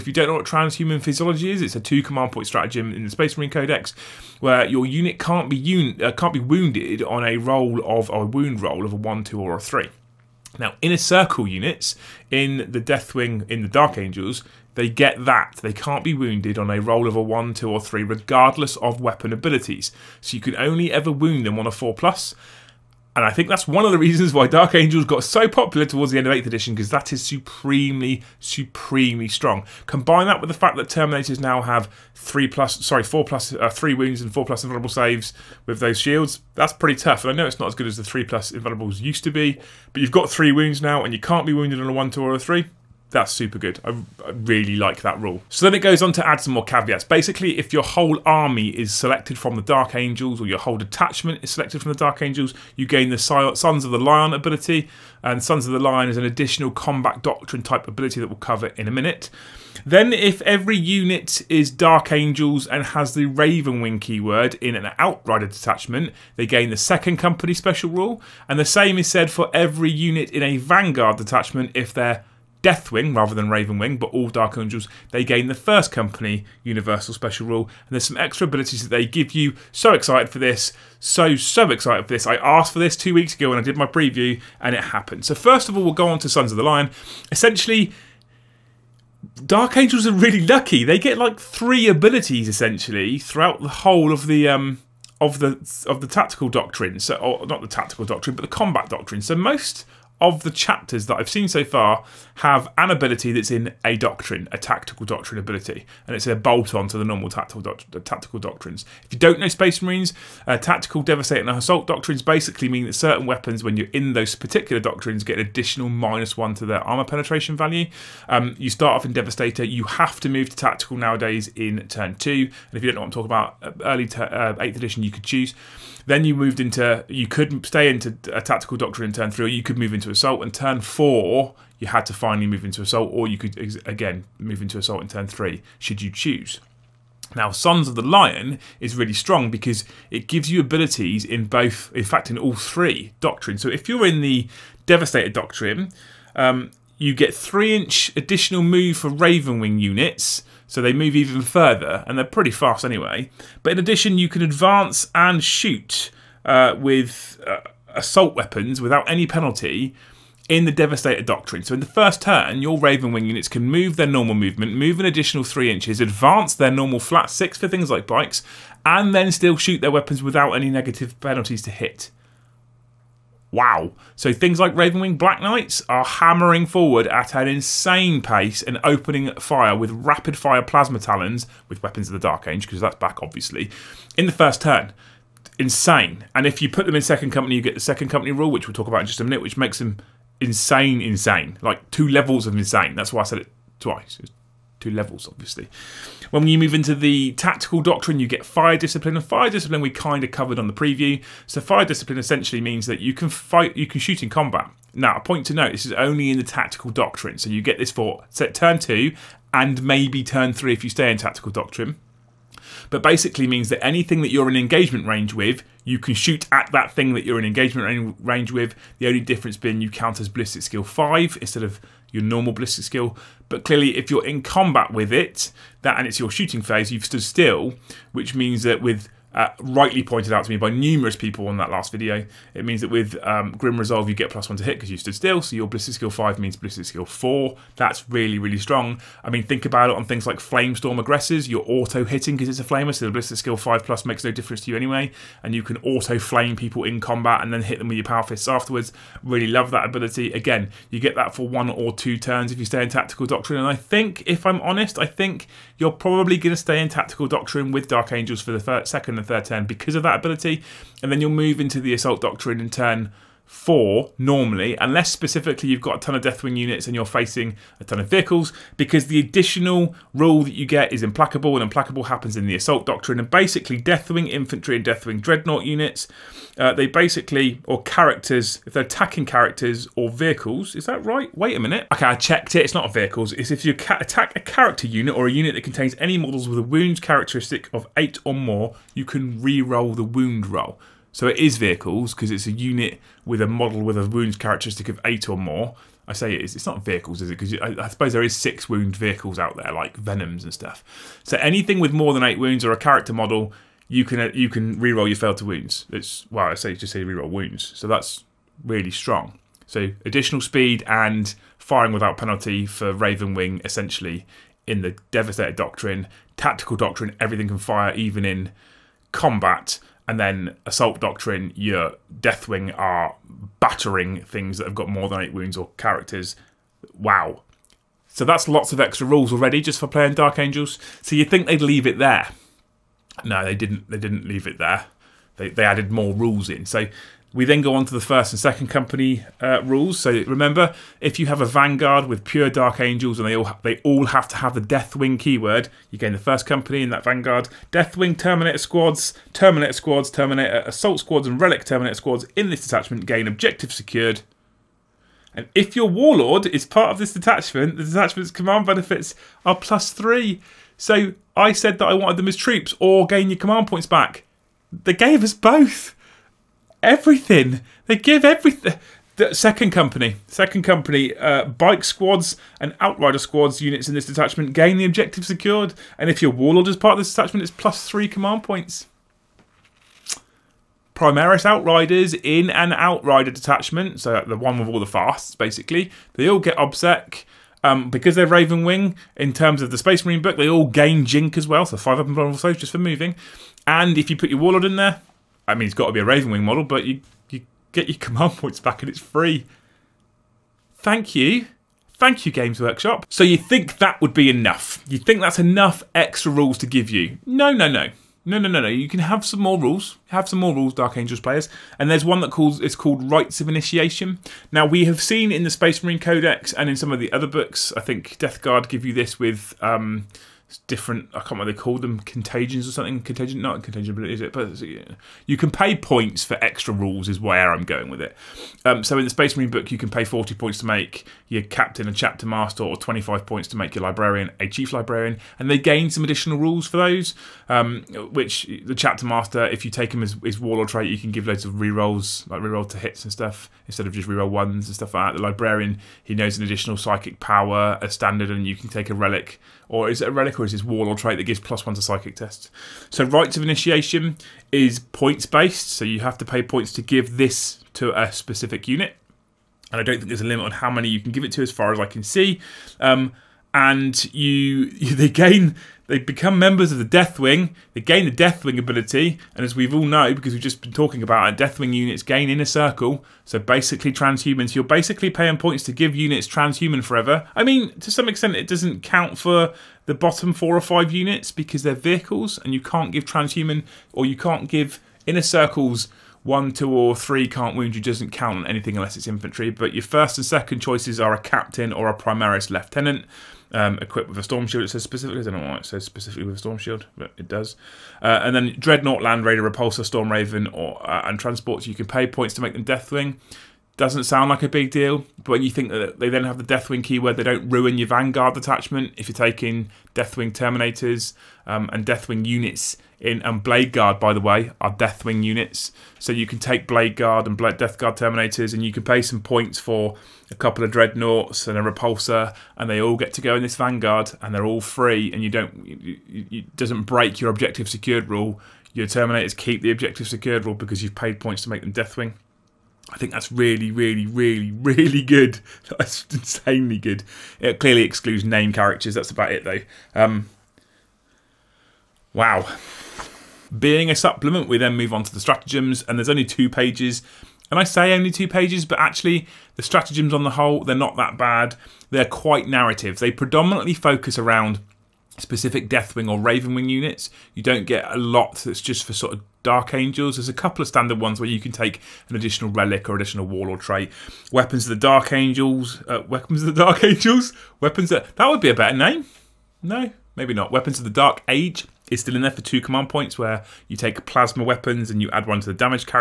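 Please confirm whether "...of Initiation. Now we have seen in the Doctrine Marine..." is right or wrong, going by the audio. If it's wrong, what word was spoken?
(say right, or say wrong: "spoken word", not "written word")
wrong: "Space", not "Doctrine".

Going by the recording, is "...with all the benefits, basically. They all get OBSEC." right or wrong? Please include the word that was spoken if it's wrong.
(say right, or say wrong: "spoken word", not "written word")
wrong: "fasts", not "benefits".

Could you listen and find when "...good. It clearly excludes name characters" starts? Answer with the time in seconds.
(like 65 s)
536 s.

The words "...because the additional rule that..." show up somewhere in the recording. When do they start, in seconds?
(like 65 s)
268 s.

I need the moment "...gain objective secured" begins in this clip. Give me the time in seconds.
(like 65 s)
353 s.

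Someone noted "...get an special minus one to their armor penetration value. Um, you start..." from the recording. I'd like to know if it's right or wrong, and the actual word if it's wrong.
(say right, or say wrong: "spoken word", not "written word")
wrong: "additional", not "special".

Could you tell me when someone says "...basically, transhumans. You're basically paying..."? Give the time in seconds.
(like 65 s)
473 s.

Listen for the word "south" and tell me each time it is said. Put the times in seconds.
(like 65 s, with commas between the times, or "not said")
not said.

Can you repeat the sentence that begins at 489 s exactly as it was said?
But your first and second choices are a captain or a primaris lieutenant um, equipped with a storm shield.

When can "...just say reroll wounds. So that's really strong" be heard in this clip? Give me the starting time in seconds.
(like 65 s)
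306 s.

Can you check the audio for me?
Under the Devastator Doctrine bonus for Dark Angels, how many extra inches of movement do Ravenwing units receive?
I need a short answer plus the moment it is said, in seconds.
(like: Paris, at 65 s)
3 inches, at 147 s.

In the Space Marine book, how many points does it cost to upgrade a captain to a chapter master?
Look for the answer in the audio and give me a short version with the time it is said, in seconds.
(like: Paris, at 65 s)
40, at 430 s.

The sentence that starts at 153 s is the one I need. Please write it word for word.
But in addition, you can advance and shoot uh, with.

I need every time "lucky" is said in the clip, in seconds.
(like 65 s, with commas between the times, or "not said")
90 s.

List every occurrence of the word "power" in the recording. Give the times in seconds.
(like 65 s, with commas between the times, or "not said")
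248 s, 447 s.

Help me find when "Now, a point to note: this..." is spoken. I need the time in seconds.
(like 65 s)
204 s.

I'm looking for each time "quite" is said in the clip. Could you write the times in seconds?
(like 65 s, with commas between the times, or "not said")
552 s.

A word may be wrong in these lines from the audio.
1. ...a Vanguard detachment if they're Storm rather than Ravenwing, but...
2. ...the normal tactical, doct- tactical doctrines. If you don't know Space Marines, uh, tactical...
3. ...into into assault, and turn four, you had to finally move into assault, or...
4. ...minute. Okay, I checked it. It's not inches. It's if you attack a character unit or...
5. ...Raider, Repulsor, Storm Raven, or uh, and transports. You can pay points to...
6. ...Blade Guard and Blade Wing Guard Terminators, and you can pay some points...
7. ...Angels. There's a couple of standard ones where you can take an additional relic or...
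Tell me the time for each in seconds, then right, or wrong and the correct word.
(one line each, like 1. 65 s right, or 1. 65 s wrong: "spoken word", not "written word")
1. 70 s wrong: "Deathwing", not "Storm"
2. 106 s right
3. 129 s right
4. 281 s wrong: "vehicles", not "inches"
5. 499 s right
6. 516 s wrong: "Death", not "Wing"
7. 559 s right.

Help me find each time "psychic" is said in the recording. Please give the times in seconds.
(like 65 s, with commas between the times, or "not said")
446 s, 451 s.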